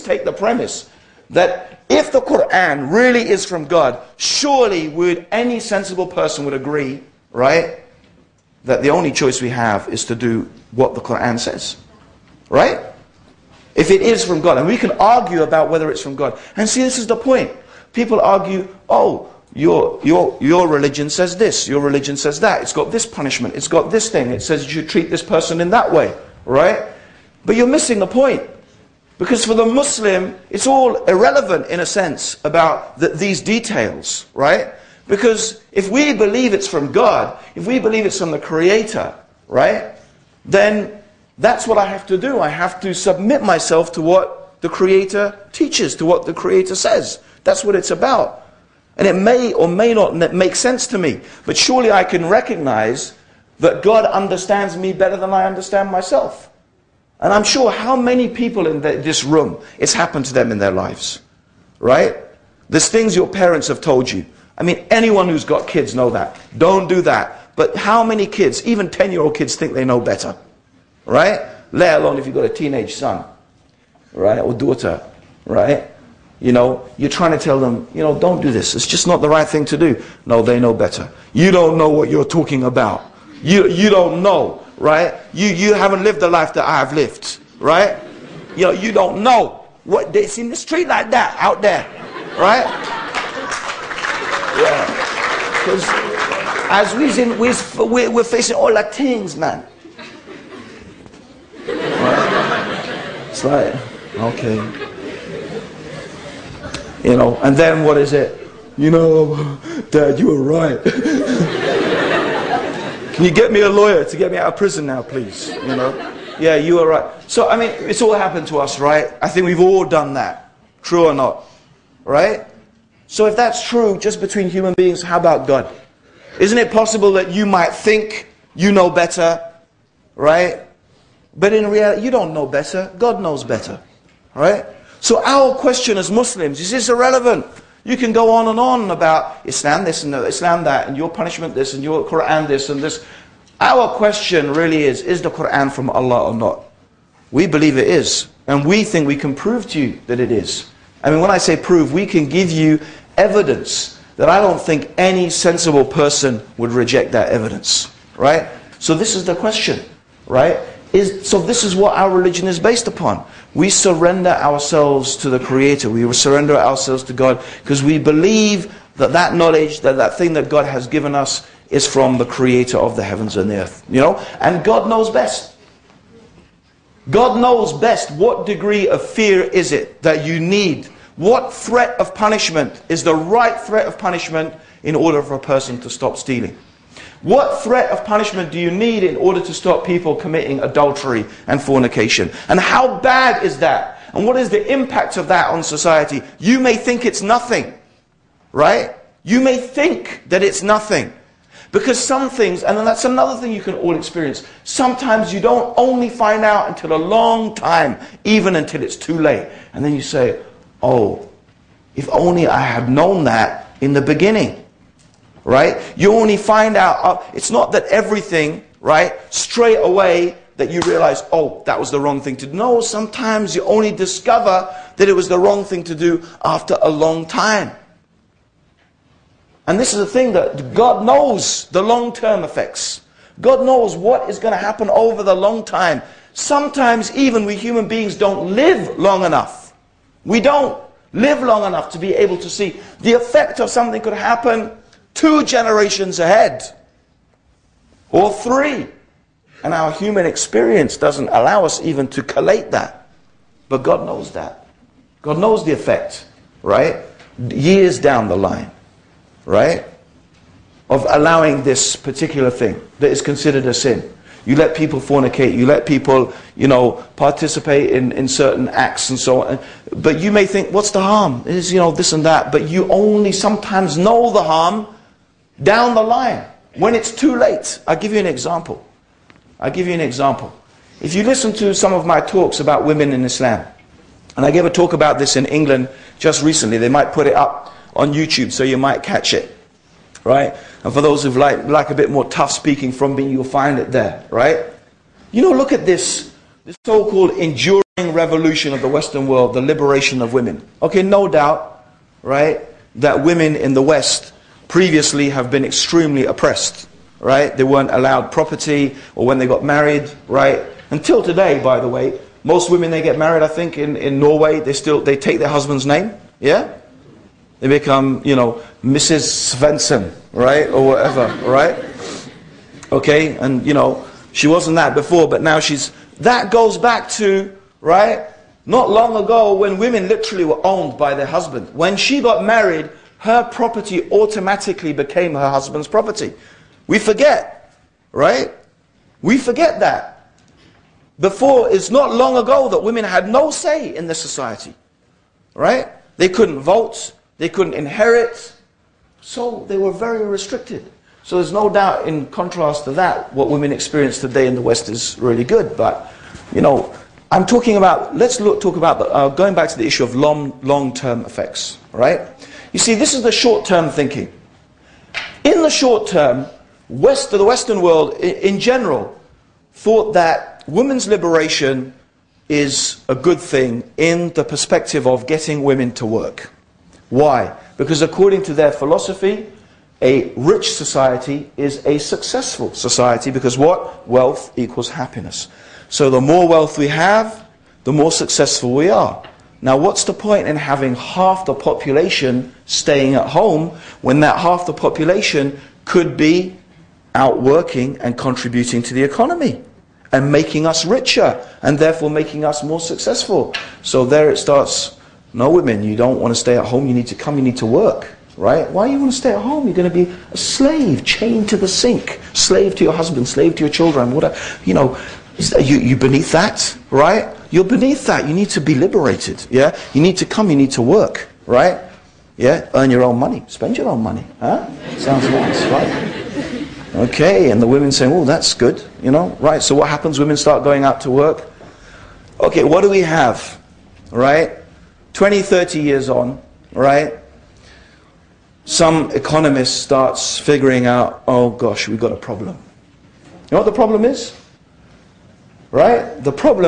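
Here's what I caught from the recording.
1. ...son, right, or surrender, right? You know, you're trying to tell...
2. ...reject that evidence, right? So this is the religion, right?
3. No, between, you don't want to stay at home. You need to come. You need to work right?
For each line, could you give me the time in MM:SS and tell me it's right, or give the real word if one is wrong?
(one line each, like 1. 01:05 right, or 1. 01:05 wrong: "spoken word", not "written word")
1. 01:12 wrong: "daughter", not "surrender"
2. 02:36 wrong: "question", not "religion"
3. 06:45 wrong: "women", not "between".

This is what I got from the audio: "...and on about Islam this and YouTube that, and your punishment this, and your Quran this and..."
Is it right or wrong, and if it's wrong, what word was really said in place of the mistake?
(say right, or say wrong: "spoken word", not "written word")
wrong: "Islam", not "YouTube".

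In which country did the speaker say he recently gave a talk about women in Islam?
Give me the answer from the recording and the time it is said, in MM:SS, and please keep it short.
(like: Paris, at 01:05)
England, at 04:45.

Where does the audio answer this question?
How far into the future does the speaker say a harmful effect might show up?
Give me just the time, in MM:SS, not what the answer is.
04:05.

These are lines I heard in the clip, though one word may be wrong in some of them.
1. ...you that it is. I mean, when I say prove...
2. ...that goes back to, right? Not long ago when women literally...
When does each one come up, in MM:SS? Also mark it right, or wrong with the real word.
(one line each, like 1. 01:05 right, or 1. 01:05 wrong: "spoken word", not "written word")
1. 02:29 right
2. 05:26 right.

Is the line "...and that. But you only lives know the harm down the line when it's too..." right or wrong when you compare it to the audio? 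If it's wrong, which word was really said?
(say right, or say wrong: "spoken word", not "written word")
wrong: "sometimes", not "lives".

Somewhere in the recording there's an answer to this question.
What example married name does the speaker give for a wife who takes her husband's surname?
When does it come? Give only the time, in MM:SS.
05:18.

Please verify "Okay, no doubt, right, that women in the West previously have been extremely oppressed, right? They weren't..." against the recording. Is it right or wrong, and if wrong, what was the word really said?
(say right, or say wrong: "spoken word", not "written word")
right.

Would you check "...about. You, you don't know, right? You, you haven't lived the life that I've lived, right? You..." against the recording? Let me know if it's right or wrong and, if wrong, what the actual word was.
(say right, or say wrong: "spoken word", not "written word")
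right.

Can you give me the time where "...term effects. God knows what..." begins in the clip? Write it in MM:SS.
03:52.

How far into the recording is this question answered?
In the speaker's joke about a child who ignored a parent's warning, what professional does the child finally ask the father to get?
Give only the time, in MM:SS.
01:53.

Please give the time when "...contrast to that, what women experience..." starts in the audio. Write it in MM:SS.
05:52.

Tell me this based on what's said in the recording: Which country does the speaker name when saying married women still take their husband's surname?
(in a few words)
Norway.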